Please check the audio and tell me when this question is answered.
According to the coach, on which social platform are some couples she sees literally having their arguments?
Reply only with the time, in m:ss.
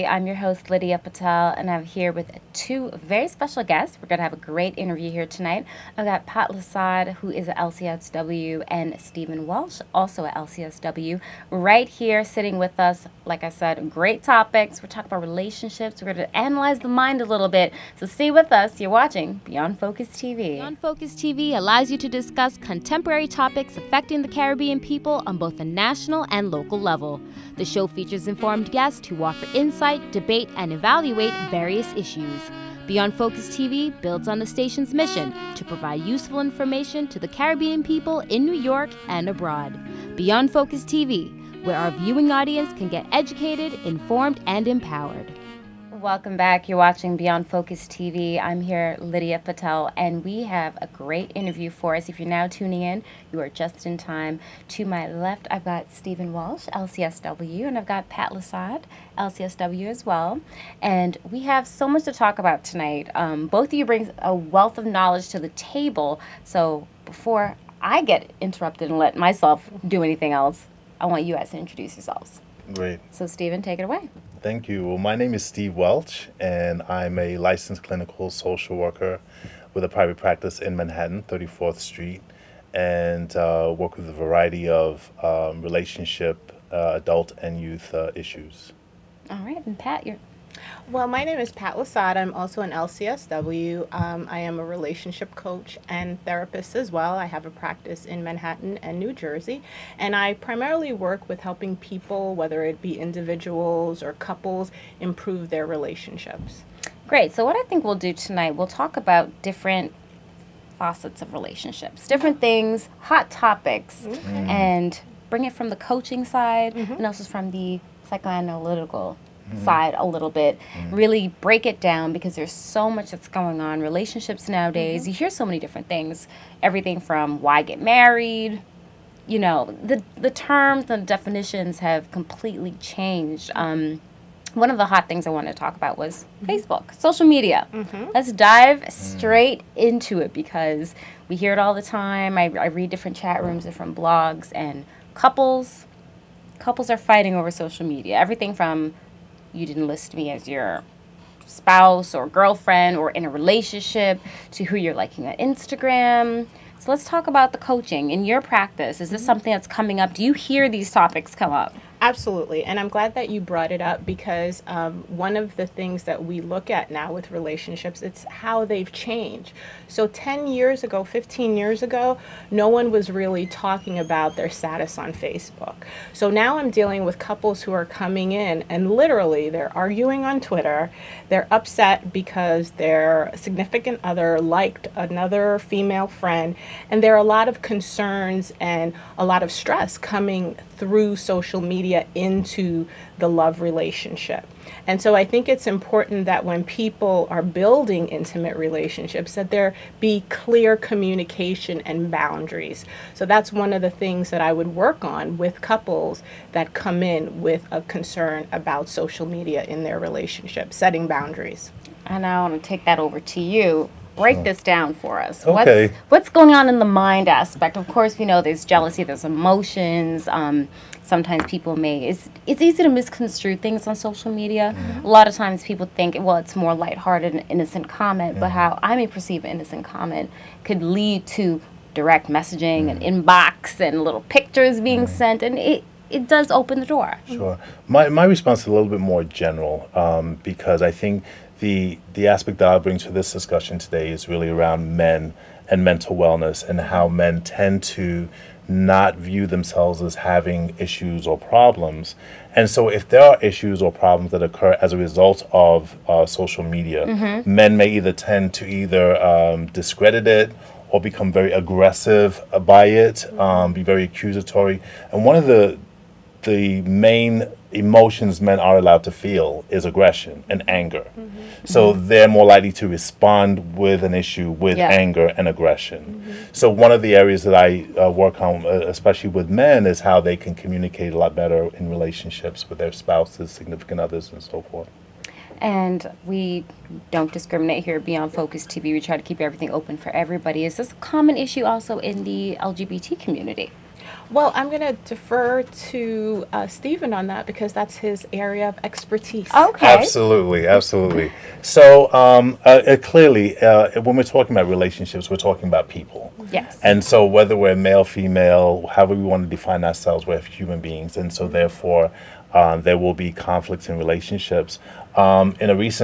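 3:00.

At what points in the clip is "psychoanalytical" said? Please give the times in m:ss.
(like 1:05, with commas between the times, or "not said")
1:58.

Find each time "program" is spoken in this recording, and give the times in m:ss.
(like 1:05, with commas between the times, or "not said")
not said.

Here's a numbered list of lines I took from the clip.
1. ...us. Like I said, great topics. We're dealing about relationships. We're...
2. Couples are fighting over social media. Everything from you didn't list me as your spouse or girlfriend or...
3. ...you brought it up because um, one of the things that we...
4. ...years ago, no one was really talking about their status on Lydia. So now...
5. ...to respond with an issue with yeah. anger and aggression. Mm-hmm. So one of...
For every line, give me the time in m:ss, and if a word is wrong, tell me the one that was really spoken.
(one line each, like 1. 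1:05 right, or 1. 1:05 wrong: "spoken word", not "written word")
1. 0:12 wrong: "talking", not "dealing"
2. 2:26 right
3. 2:43 right
4. 2:51 wrong: "Facebook", not "Lydia"
5. 4:32 right.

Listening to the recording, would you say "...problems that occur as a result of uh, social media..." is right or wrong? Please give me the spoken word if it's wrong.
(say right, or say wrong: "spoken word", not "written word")
right.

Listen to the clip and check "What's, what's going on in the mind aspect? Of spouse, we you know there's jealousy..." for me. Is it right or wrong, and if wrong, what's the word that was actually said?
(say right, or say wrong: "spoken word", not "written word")
wrong: "course", not "spouse".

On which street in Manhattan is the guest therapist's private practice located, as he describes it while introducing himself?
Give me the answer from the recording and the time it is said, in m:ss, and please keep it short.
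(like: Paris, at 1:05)
34th Street, at 1:21.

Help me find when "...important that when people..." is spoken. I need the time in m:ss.
3:15.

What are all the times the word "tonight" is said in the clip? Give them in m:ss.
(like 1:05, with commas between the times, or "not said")
0:05, 1:02, 1:48.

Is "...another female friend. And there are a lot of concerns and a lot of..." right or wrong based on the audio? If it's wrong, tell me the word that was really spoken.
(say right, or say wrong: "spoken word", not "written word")
right.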